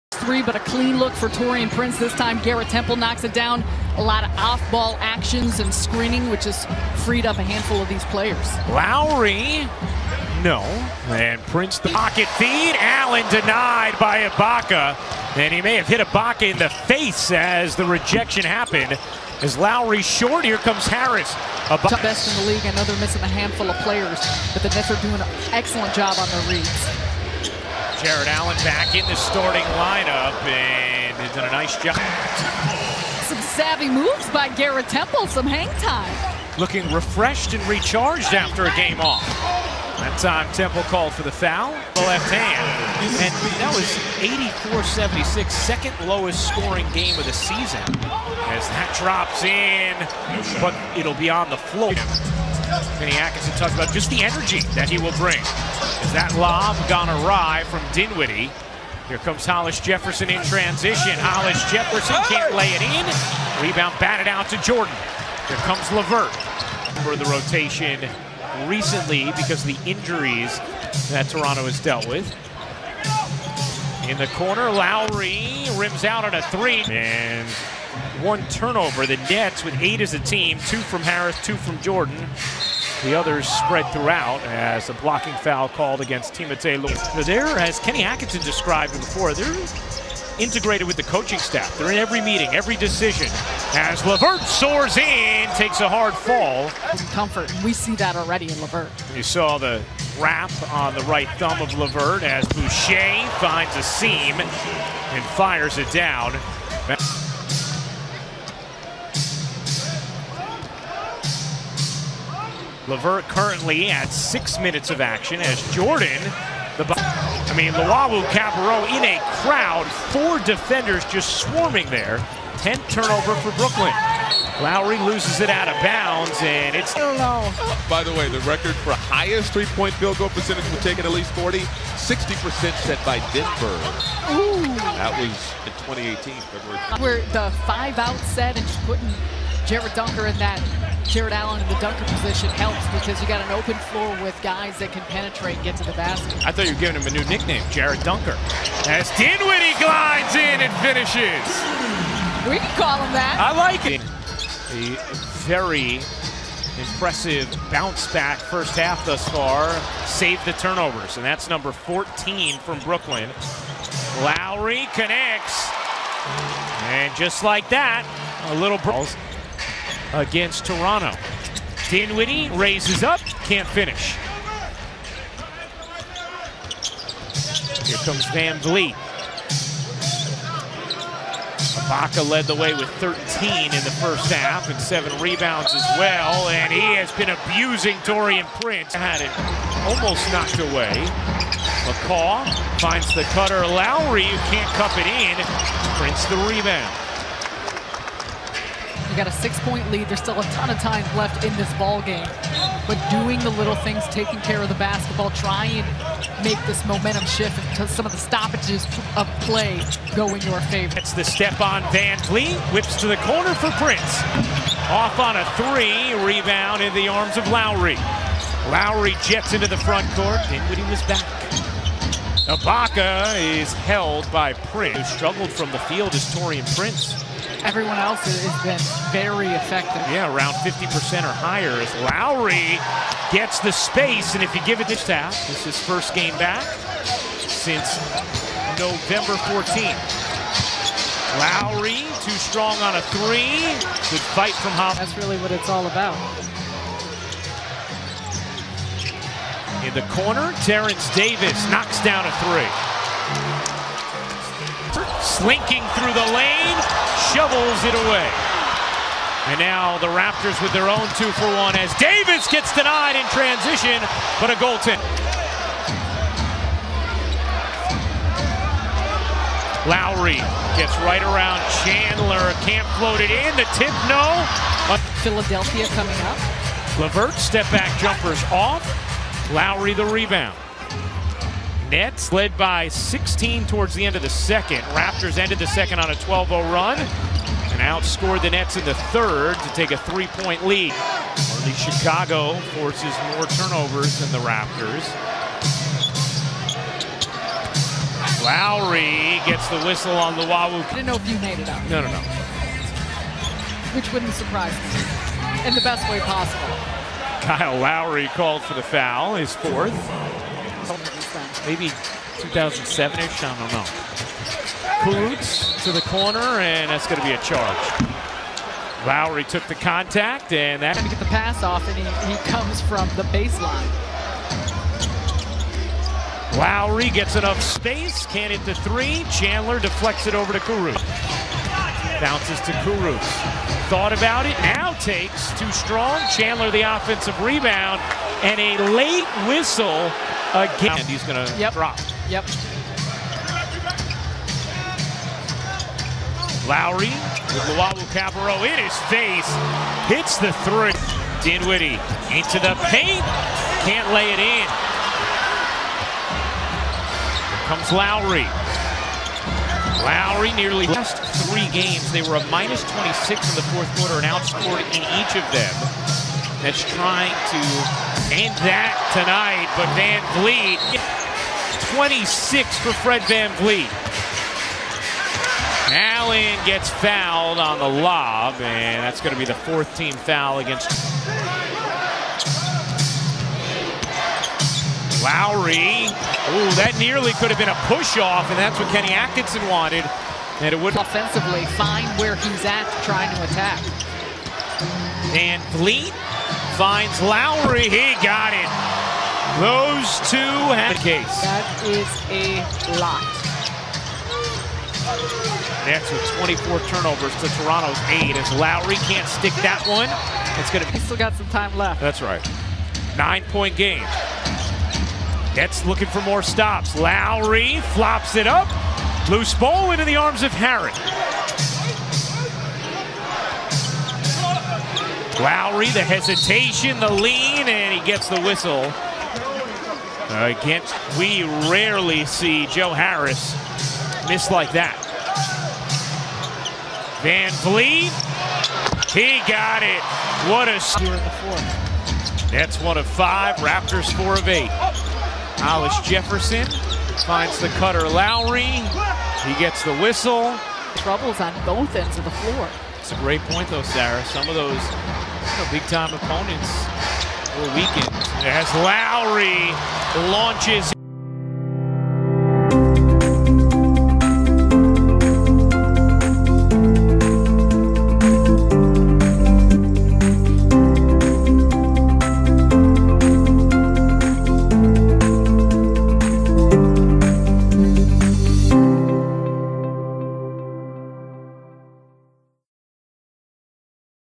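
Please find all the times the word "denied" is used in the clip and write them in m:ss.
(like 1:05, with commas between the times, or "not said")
0:13, 4:22.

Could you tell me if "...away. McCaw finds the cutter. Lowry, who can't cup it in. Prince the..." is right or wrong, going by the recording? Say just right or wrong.
right.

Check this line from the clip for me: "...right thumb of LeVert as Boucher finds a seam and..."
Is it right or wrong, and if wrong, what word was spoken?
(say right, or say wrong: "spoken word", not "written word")
right.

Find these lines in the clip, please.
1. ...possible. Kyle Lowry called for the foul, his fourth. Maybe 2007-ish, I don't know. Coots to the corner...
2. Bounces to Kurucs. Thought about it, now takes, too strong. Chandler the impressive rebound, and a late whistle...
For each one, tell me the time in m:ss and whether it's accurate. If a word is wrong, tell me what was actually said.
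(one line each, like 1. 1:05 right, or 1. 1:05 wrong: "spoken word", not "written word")
1. 5:06 right
2. 5:32 wrong: "offensive", not "impressive".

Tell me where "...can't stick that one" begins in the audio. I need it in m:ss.
6:49.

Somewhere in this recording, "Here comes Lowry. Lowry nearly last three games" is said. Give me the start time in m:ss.
5:57.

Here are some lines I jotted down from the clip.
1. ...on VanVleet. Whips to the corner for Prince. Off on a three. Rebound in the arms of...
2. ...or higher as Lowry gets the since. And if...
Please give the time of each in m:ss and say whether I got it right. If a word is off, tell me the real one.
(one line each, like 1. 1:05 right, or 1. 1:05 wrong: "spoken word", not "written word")
1. 3:31 right
2. 3:51 wrong: "space", not "since".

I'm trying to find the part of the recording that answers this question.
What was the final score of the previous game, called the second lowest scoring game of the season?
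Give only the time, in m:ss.
0:44.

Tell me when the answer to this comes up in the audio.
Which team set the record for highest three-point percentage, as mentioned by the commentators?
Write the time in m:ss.
2:13.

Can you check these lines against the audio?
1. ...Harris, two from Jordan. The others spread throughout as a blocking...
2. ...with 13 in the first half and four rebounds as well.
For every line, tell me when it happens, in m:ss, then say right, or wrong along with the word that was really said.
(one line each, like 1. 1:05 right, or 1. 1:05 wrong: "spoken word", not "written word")
1. 1:21 right
2. 3:02 wrong: "seven", not "four".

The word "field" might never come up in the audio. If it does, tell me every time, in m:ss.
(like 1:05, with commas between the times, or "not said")
2:09, 3:45.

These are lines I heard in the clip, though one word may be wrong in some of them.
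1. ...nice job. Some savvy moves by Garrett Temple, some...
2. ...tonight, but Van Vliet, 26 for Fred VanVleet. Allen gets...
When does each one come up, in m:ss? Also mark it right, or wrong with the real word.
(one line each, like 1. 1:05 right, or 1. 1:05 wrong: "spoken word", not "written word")
1. 0:31 right
2. 6:09 right.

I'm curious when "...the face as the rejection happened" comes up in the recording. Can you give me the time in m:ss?
0:16.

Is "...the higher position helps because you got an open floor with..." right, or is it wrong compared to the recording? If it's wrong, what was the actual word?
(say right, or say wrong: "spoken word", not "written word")
wrong: "dunker", not "higher".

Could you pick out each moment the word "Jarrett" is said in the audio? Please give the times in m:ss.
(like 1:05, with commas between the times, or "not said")
0:28, 2:21.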